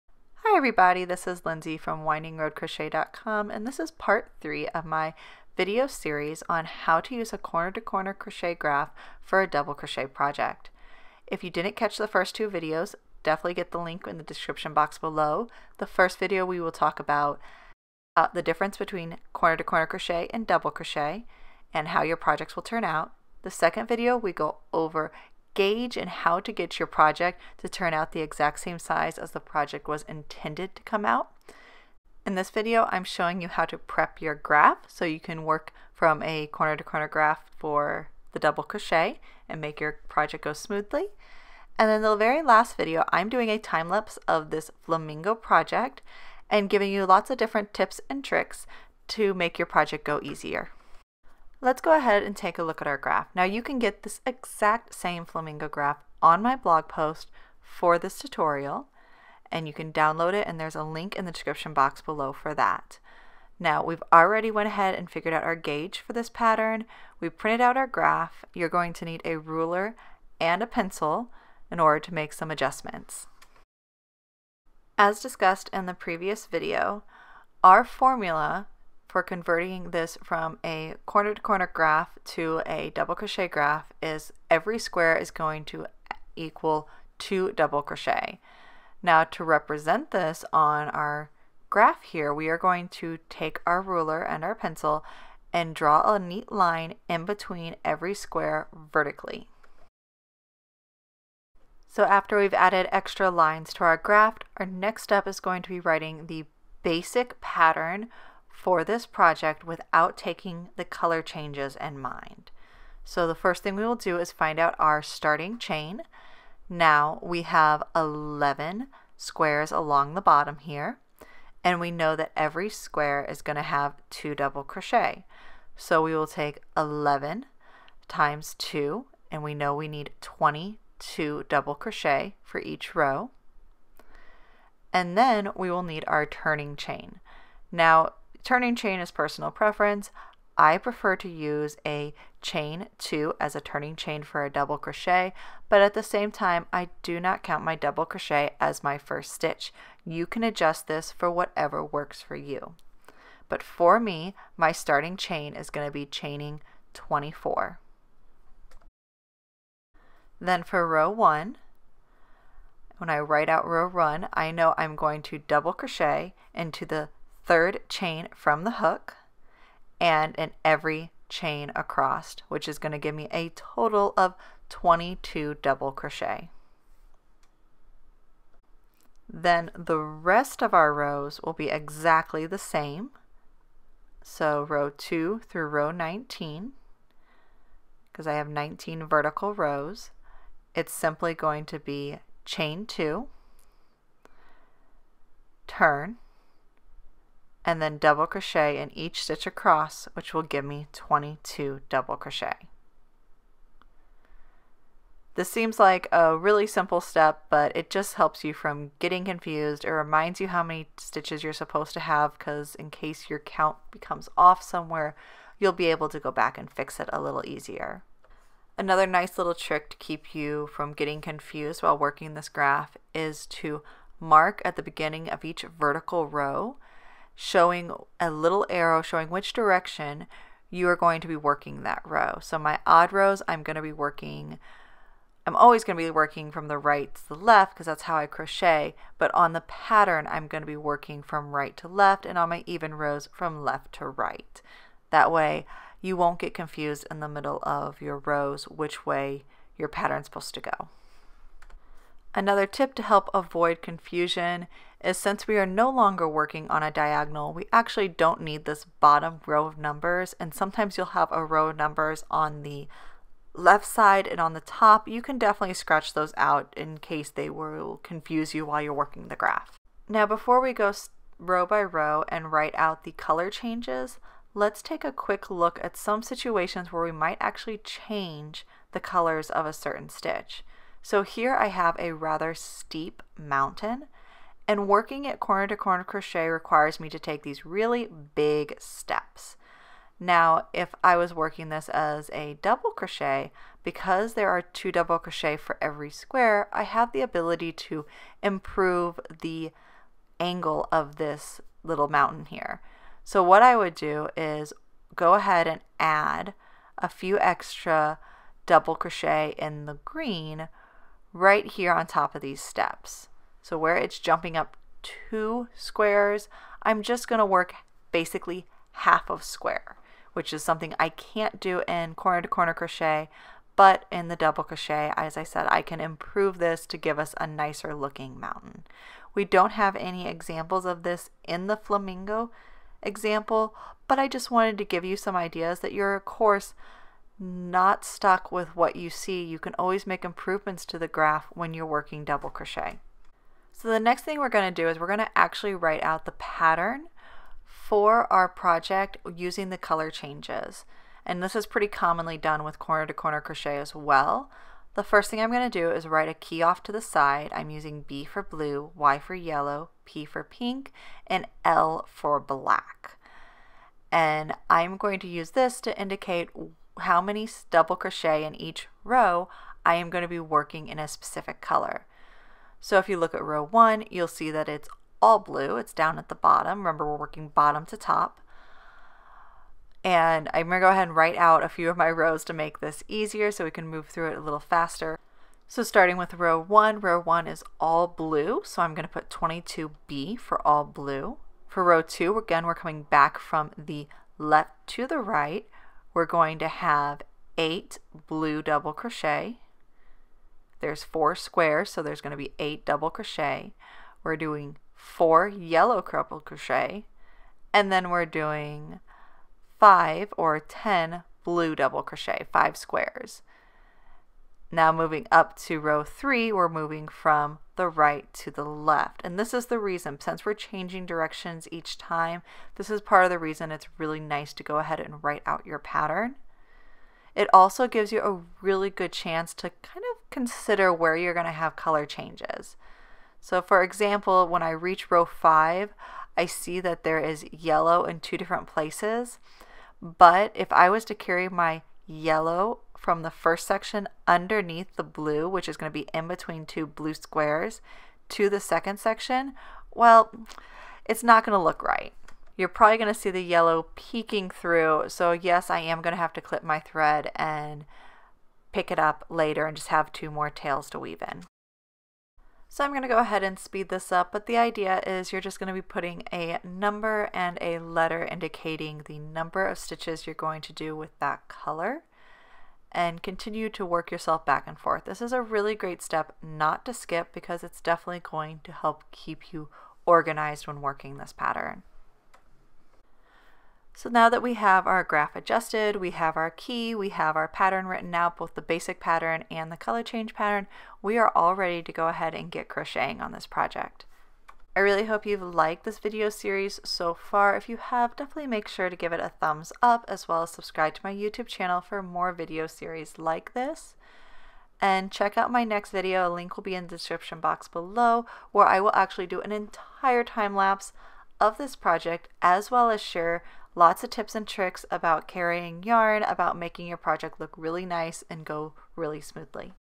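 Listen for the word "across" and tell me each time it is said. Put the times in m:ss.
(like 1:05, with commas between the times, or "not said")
2:51, 3:19.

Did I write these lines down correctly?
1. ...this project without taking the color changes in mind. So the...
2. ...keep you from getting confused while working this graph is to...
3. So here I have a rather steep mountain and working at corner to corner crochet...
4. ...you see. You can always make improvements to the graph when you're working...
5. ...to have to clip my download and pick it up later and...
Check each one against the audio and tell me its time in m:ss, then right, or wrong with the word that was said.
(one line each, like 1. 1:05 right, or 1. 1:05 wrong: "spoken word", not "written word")
1. 1:48 right
2. 3:39 right
3. 4:41 right
4. 5:38 right
5. 7:36 wrong: "thread", not "download".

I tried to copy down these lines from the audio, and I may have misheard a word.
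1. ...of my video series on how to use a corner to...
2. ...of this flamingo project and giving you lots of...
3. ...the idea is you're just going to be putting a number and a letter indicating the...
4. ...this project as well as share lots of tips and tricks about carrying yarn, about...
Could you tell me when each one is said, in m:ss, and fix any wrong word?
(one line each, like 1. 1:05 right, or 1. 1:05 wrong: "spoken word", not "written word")
1. 0:04 right
2. 0:44 right
3. 7:44 right
4. 8:31 right.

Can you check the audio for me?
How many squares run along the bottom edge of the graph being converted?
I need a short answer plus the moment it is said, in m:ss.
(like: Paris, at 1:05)
11, at 1:57.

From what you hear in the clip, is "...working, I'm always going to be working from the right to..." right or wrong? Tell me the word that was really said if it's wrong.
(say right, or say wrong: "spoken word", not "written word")
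right.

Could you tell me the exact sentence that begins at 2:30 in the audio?
You can adjust this for whatever works for you.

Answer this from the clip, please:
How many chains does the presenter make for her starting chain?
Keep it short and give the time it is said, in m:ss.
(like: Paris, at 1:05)
24, at 2:36.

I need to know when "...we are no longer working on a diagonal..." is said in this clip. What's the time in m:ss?
4:15.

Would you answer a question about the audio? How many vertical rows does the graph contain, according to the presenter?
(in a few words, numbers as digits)
19.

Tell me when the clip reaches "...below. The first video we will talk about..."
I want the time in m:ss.
0:14.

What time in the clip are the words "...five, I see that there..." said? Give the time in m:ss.
7:15.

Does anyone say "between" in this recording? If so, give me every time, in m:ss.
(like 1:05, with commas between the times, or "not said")
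0:18, 1:37, 7:26.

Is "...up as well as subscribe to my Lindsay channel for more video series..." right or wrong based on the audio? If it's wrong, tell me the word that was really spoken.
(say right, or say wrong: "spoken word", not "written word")
wrong: "YouTube", not "Lindsay".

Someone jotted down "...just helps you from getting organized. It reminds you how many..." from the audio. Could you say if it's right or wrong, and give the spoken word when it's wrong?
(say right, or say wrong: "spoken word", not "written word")
wrong: "confused", not "organized".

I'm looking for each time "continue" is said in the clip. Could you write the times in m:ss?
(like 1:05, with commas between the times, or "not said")
7:53.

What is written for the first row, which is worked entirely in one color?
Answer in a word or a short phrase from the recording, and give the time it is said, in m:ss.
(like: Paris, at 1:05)
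22B, at 6:29.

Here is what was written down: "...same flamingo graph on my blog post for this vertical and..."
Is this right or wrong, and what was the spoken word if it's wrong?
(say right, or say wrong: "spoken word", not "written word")
wrong: "tutorial", not "vertical".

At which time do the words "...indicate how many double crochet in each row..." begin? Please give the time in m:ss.
6:05.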